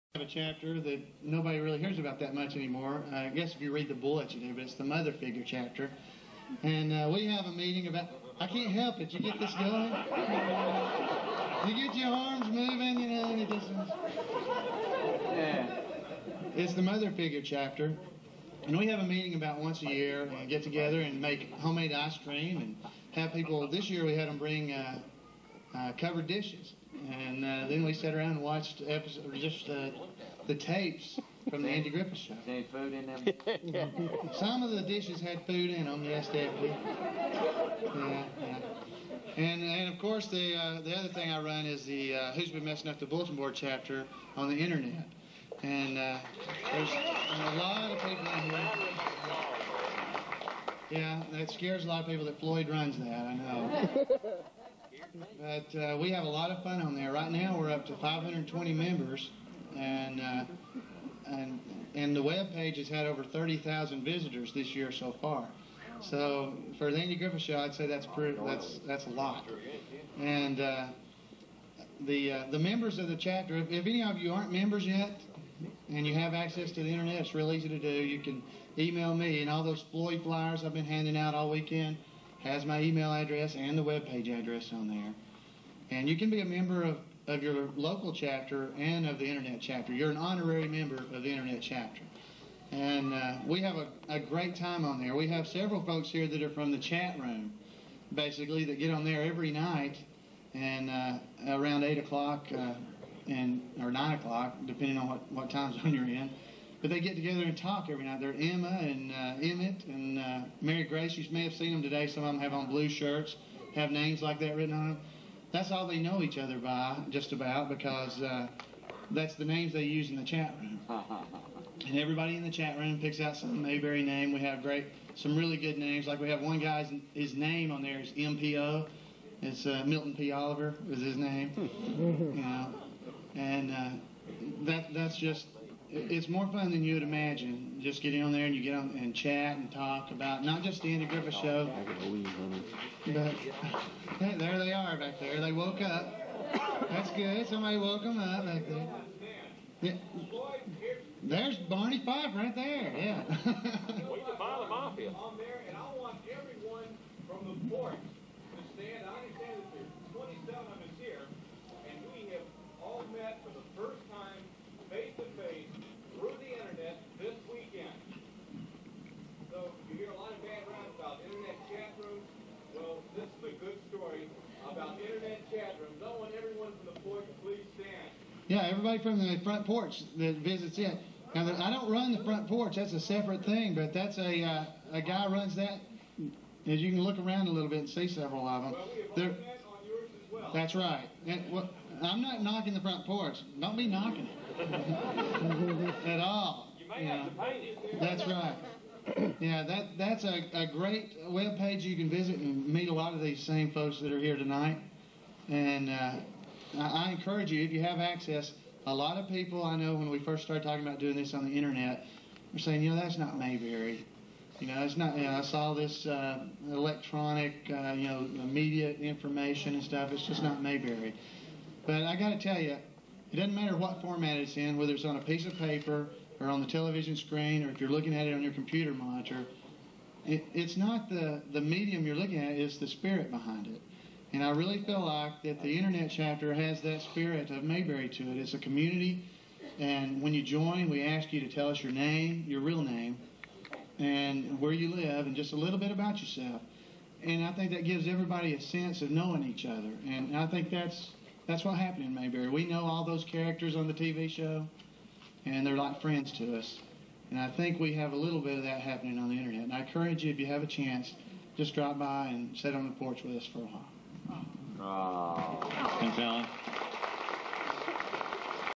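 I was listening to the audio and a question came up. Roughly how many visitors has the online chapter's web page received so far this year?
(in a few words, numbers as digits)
over 30,000.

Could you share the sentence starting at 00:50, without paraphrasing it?
Yeah, that scares a lot of people that Floyd runs that.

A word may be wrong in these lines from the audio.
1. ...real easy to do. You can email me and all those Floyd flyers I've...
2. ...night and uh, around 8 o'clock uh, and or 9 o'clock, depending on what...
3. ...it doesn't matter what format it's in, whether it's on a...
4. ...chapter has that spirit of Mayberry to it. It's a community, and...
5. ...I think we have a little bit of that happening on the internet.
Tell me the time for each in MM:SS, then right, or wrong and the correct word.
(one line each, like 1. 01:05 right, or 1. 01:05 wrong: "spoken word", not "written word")
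1. 01:17 right
2. 01:39 right
3. 03:43 right
4. 03:56 right
5. 04:17 right.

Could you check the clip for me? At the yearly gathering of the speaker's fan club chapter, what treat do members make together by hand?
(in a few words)
homemade ice cream.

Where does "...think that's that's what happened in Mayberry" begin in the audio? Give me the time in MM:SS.
04:10.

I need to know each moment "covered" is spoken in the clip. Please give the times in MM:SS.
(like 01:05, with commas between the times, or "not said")
00:25.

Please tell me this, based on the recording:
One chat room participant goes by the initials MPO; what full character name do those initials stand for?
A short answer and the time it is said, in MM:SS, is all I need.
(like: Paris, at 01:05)
Milton P. Oliver, at 02:09.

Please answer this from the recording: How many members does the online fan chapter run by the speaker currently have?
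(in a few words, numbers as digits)
520.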